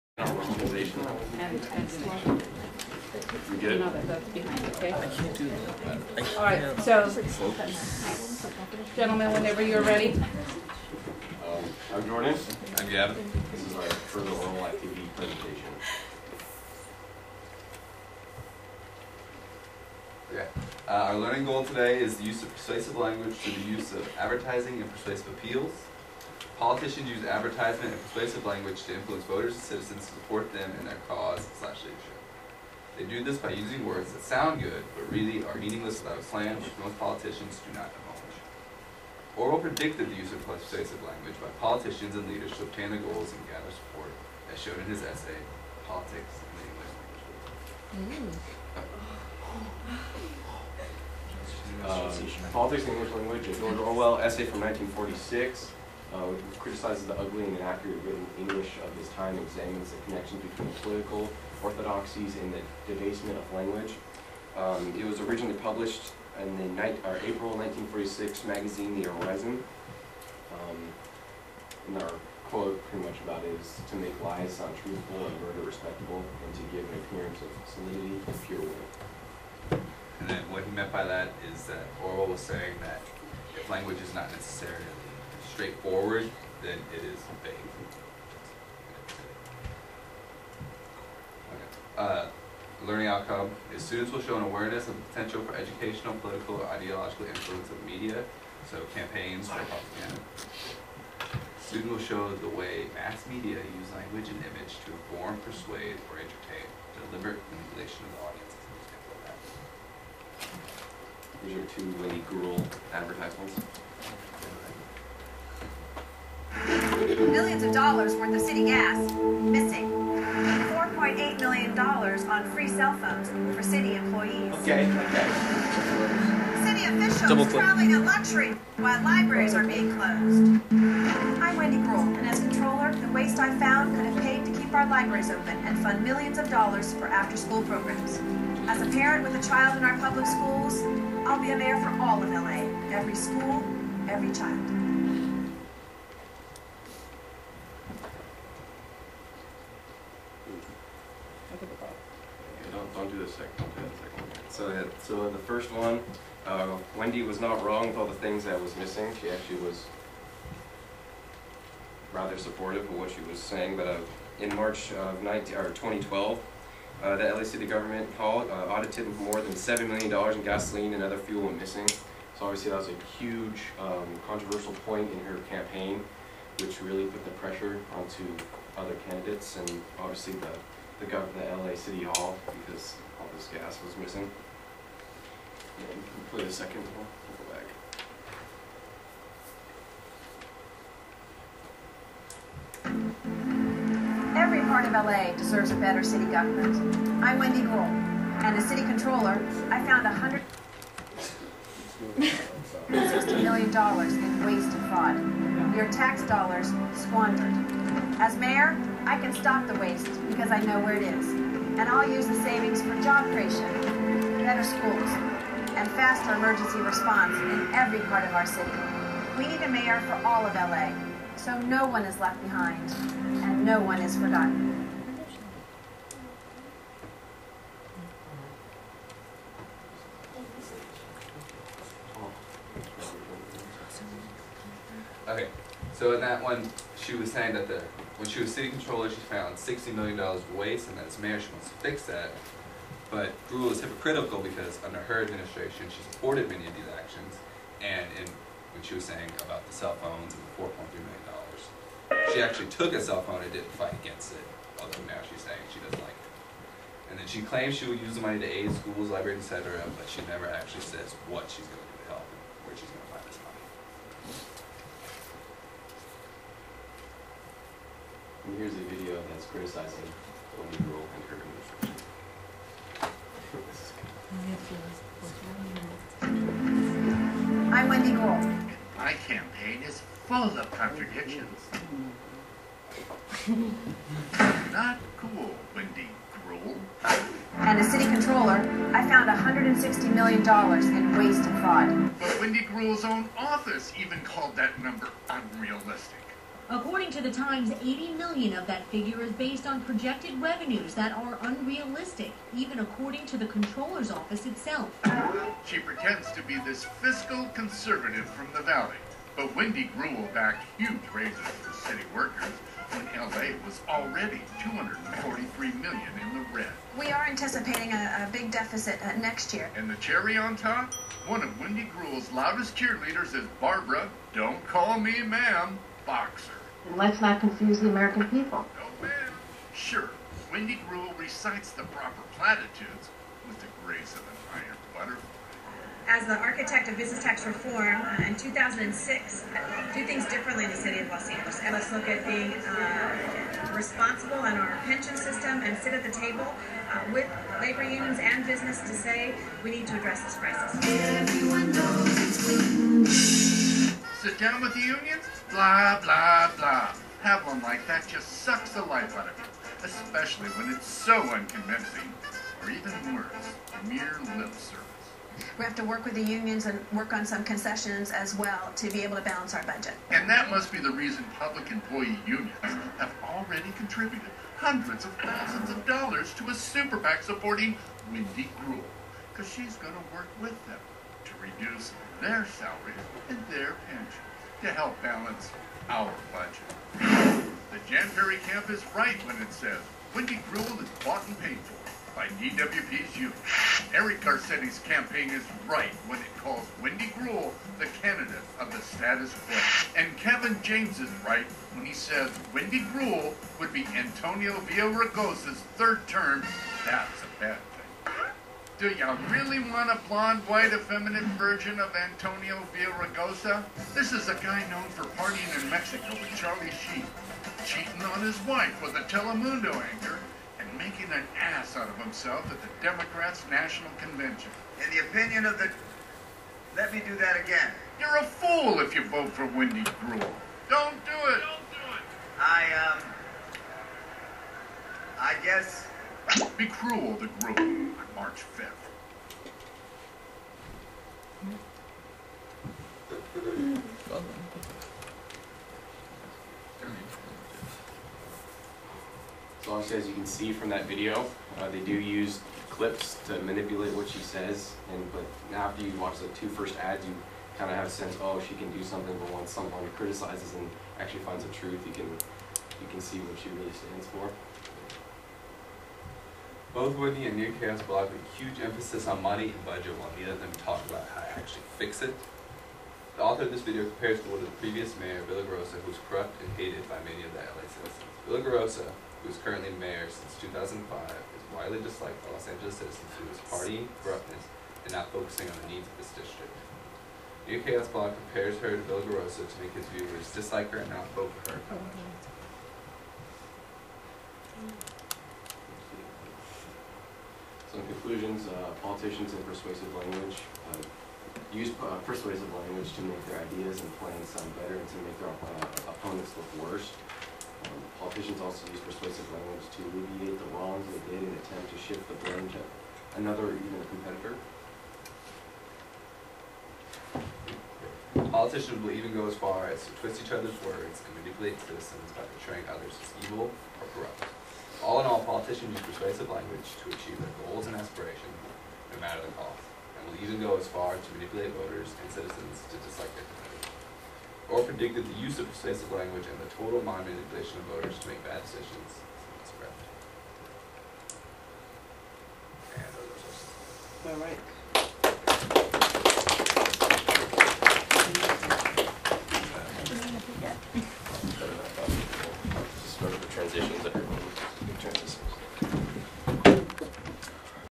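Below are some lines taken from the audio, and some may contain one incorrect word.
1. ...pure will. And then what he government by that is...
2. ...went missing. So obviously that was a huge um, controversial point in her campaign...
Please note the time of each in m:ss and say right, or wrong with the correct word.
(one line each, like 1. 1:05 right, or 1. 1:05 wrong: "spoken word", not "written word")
1. 1:18 wrong: "meant", not "government"
2. 2:51 right.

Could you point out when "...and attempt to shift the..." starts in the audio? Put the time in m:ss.
8:31.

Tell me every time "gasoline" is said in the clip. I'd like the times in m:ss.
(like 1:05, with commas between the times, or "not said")
2:50.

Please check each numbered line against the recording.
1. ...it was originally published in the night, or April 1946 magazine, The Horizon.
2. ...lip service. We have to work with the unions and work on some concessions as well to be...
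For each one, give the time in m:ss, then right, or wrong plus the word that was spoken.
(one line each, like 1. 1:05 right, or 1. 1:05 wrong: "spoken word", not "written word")
1. 1:04 right
2. 6:04 right.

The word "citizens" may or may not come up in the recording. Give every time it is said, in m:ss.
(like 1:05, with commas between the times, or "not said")
0:29, 7:57, 8:02, 8:41, 8:52.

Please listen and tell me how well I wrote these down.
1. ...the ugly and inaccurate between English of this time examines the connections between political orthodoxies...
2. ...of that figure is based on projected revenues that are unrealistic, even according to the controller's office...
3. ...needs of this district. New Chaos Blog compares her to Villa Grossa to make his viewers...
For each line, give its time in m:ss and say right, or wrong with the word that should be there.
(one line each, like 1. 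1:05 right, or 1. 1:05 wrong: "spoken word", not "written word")
1. 0:57 wrong: "written", not "between"
2. 4:58 right
3. 8:05 right.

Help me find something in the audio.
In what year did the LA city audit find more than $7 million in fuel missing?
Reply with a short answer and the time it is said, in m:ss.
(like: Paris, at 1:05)
2012, at 2:45.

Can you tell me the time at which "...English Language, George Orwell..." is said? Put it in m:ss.
0:52.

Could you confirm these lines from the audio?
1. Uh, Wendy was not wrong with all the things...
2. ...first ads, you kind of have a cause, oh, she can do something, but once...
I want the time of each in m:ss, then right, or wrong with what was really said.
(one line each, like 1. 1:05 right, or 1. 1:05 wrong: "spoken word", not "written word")
1. 2:36 right
2. 7:36 wrong: "sense", not "cause".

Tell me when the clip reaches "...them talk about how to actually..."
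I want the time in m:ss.
7:50.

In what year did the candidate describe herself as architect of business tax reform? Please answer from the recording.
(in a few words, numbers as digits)
2006.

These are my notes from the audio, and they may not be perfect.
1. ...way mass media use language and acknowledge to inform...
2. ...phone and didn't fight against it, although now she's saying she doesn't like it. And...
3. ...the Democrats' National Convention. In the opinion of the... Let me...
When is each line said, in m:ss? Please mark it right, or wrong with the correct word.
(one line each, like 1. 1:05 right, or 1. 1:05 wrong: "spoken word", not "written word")
1. 1:42 wrong: "image", not "acknowledge"
2. 4:13 right
3. 7:02 right.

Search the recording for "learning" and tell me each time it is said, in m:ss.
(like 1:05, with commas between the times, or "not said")
0:21, 1:32.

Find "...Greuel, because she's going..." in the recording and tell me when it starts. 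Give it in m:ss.
6:18.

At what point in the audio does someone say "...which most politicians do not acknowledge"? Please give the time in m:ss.
0:36.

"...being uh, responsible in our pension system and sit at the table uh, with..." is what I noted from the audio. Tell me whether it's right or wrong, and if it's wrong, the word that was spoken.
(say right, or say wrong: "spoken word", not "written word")
right.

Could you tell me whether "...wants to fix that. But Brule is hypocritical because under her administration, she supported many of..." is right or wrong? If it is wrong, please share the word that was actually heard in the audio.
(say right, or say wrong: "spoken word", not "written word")
right.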